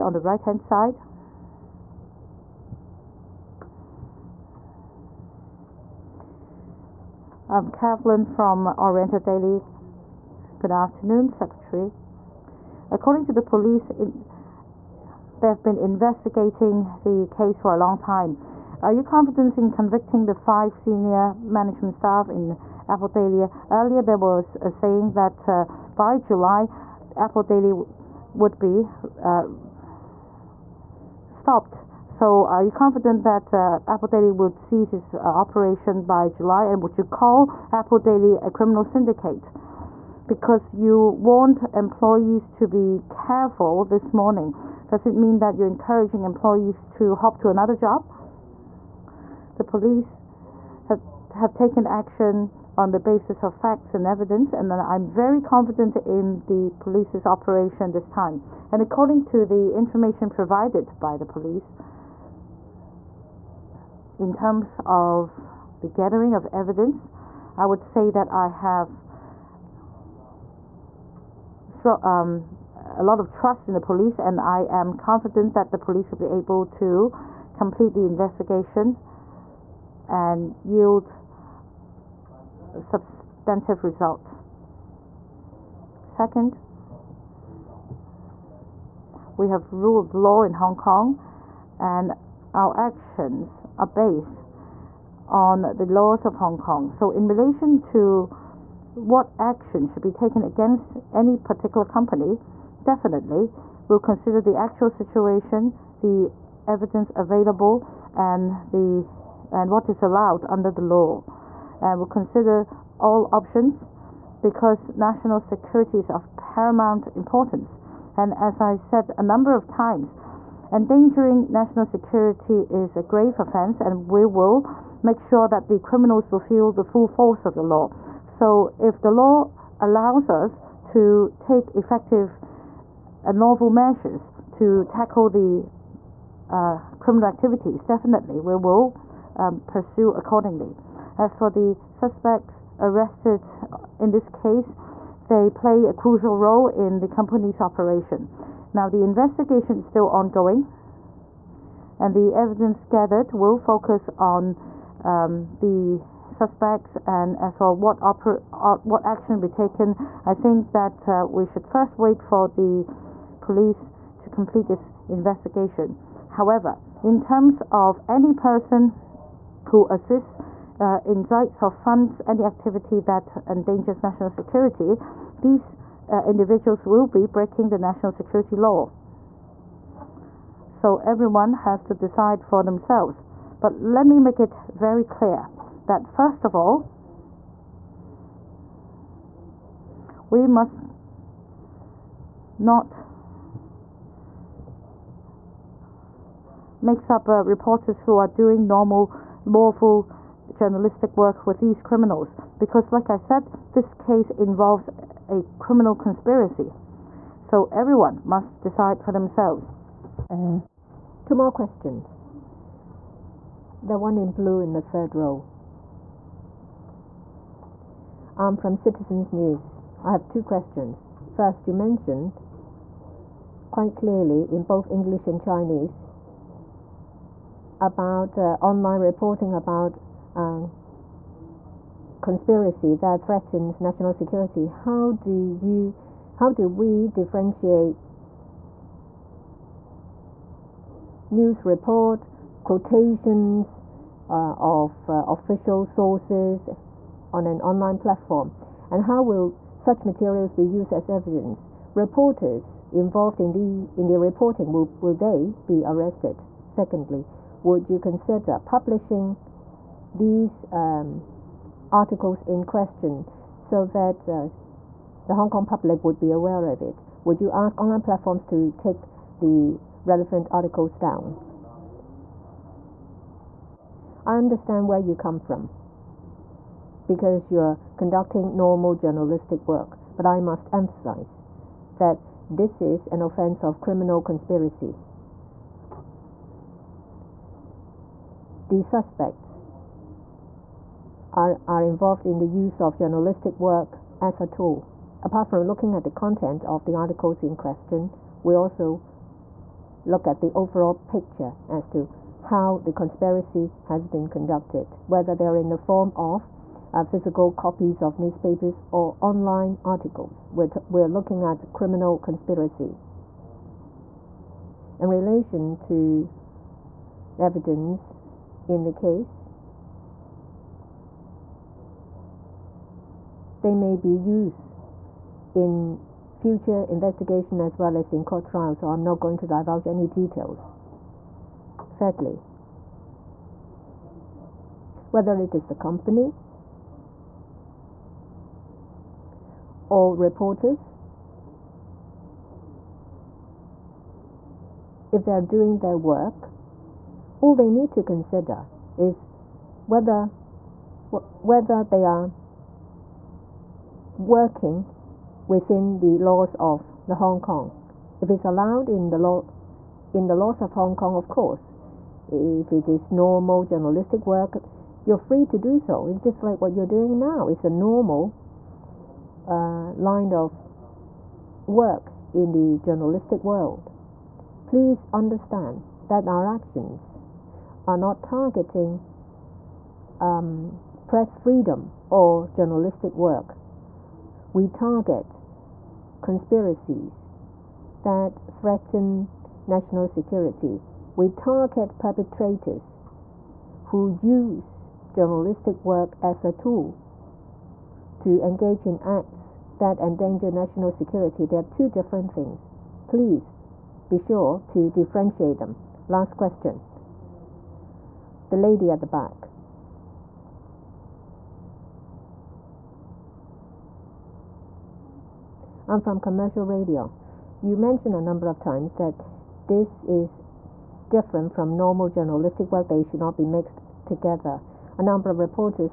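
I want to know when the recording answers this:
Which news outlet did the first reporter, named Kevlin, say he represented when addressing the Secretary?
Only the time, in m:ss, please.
0:08.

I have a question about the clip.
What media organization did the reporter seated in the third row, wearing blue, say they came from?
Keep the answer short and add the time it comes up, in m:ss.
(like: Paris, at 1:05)
Citizens News, at 3:38.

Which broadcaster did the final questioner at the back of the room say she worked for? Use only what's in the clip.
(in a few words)
Commercial radio.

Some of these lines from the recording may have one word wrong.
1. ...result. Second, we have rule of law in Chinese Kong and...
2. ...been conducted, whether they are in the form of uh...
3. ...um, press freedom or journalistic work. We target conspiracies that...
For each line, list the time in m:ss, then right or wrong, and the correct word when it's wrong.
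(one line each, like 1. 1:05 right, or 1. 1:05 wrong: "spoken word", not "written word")
1. 1:23 wrong: "Hong", not "Chinese"
2. 5:04 right
3. 6:20 right.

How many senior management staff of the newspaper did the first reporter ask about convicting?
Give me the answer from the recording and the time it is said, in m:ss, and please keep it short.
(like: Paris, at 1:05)
5, at 0:20.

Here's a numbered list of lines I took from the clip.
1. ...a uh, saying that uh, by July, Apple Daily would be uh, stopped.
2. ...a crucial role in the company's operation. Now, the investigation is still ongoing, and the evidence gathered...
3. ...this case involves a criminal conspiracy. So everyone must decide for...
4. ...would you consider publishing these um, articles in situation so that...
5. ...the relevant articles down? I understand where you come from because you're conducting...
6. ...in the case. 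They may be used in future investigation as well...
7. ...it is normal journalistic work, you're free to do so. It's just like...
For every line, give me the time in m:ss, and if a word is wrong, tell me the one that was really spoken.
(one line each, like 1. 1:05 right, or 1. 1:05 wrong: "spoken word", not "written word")
1. 0:24 right
2. 2:25 right
3. 3:23 right
4. 4:17 wrong: "question", not "situation"
5. 4:29 right
6. 5:18 right
7. 6:02 right.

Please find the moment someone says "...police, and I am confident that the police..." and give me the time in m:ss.
1:13.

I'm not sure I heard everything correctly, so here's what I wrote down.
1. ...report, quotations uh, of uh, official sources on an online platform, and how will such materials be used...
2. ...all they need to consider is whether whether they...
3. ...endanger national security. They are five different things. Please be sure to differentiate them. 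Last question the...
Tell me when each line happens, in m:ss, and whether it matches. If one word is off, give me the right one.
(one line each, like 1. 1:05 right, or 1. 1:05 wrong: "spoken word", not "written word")
1. 4:01 right
2. 5:47 right
3. 6:39 wrong: "two", not "five".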